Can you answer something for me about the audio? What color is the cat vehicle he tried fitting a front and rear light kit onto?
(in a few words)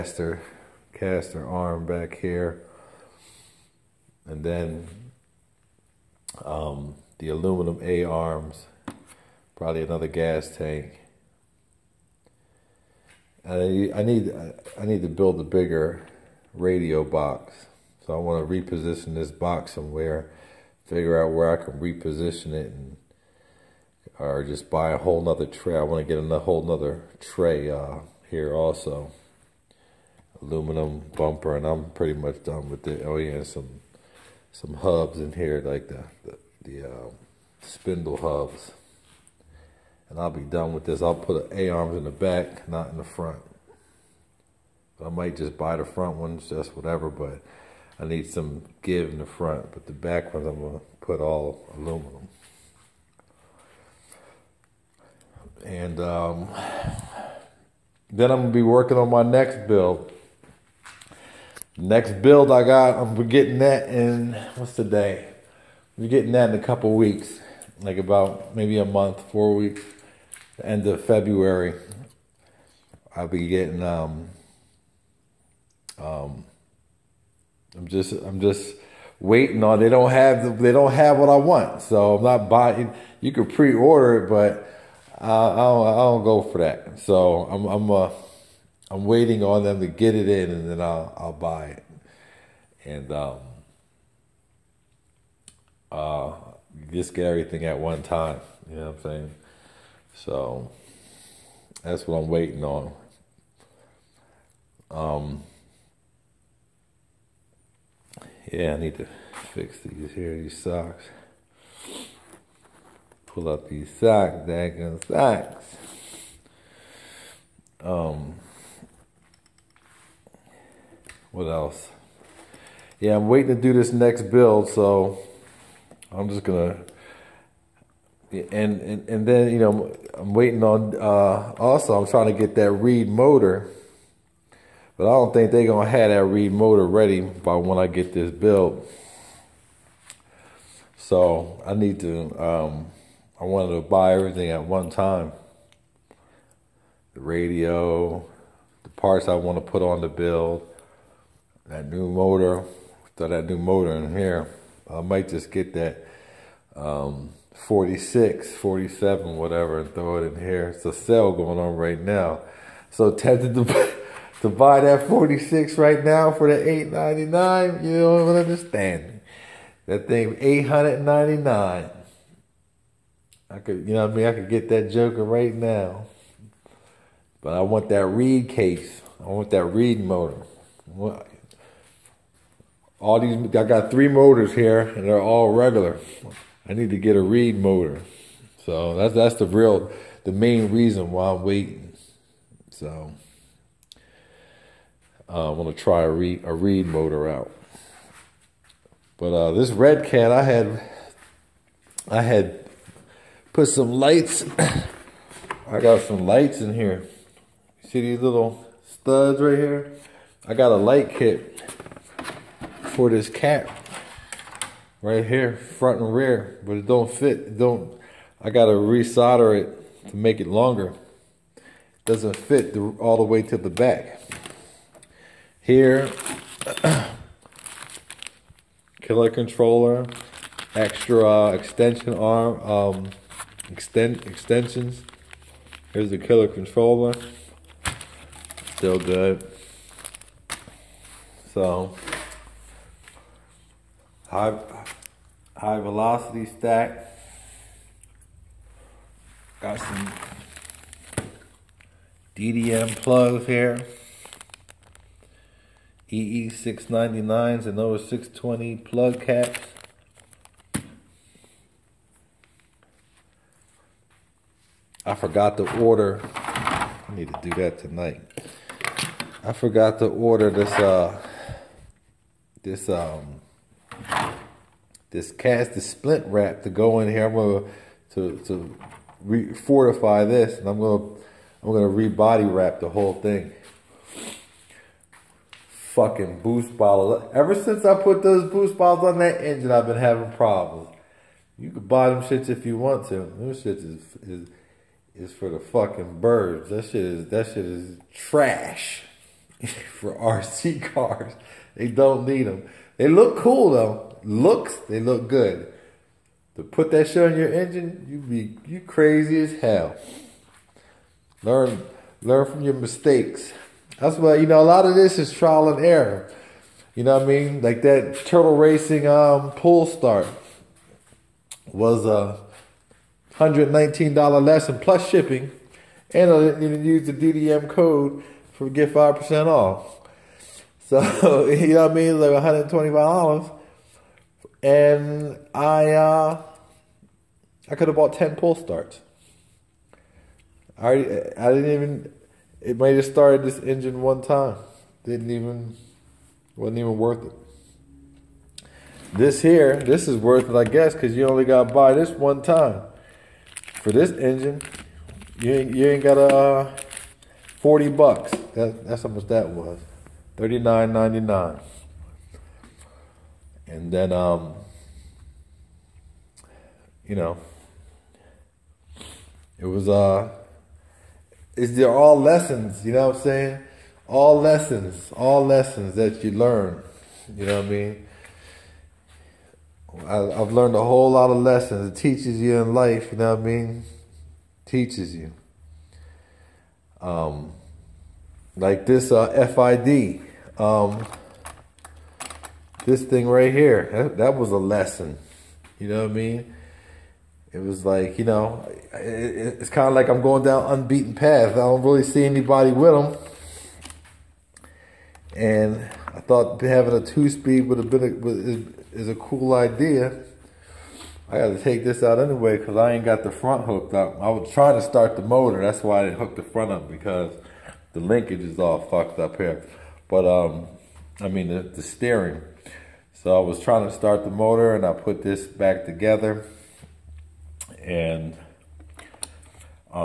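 Red.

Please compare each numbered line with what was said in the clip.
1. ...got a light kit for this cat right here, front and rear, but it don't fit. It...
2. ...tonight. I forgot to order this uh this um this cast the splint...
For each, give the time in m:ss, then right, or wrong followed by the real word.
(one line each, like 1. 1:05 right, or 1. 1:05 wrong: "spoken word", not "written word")
1. 3:30 right
2. 4:27 right.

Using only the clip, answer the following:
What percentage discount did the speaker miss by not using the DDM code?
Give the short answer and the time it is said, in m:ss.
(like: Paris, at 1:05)
5 percent, at 5:28.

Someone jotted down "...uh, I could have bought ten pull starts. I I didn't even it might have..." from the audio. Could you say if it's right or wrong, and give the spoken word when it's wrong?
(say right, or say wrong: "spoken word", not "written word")
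right.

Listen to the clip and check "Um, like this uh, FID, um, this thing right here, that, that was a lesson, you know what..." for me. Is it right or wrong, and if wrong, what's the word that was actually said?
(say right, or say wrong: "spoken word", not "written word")
right.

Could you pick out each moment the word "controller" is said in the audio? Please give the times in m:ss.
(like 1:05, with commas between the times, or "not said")
3:49, 3:56.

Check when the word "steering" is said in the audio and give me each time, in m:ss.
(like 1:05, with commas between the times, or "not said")
7:01.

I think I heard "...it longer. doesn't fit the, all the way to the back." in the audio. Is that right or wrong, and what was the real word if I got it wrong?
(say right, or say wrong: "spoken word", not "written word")
right.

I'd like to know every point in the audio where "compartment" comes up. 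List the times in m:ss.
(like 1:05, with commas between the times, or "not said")
not said.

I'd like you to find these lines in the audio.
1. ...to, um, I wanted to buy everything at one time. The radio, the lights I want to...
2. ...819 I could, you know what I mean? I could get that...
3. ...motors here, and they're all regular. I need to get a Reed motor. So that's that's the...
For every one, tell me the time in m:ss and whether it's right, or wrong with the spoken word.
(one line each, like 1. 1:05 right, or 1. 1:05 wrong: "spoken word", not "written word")
1. 2:22 wrong: "parts", not "lights"
2. 2:50 wrong: "899", not "819"
3. 3:04 right.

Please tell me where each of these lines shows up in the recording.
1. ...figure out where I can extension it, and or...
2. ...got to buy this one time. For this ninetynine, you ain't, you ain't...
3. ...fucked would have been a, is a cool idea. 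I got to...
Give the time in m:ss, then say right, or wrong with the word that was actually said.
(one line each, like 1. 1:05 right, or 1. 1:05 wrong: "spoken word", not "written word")
1. 0:20 wrong: "reposition", not "extension"
2. 5:51 wrong: "engine", not "ninetynine"
3. 6:47 wrong: "speed", not "fucked".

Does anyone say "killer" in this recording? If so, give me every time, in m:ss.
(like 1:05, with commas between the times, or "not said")
3:49, 3:56.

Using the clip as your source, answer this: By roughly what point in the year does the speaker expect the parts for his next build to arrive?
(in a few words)
End of February.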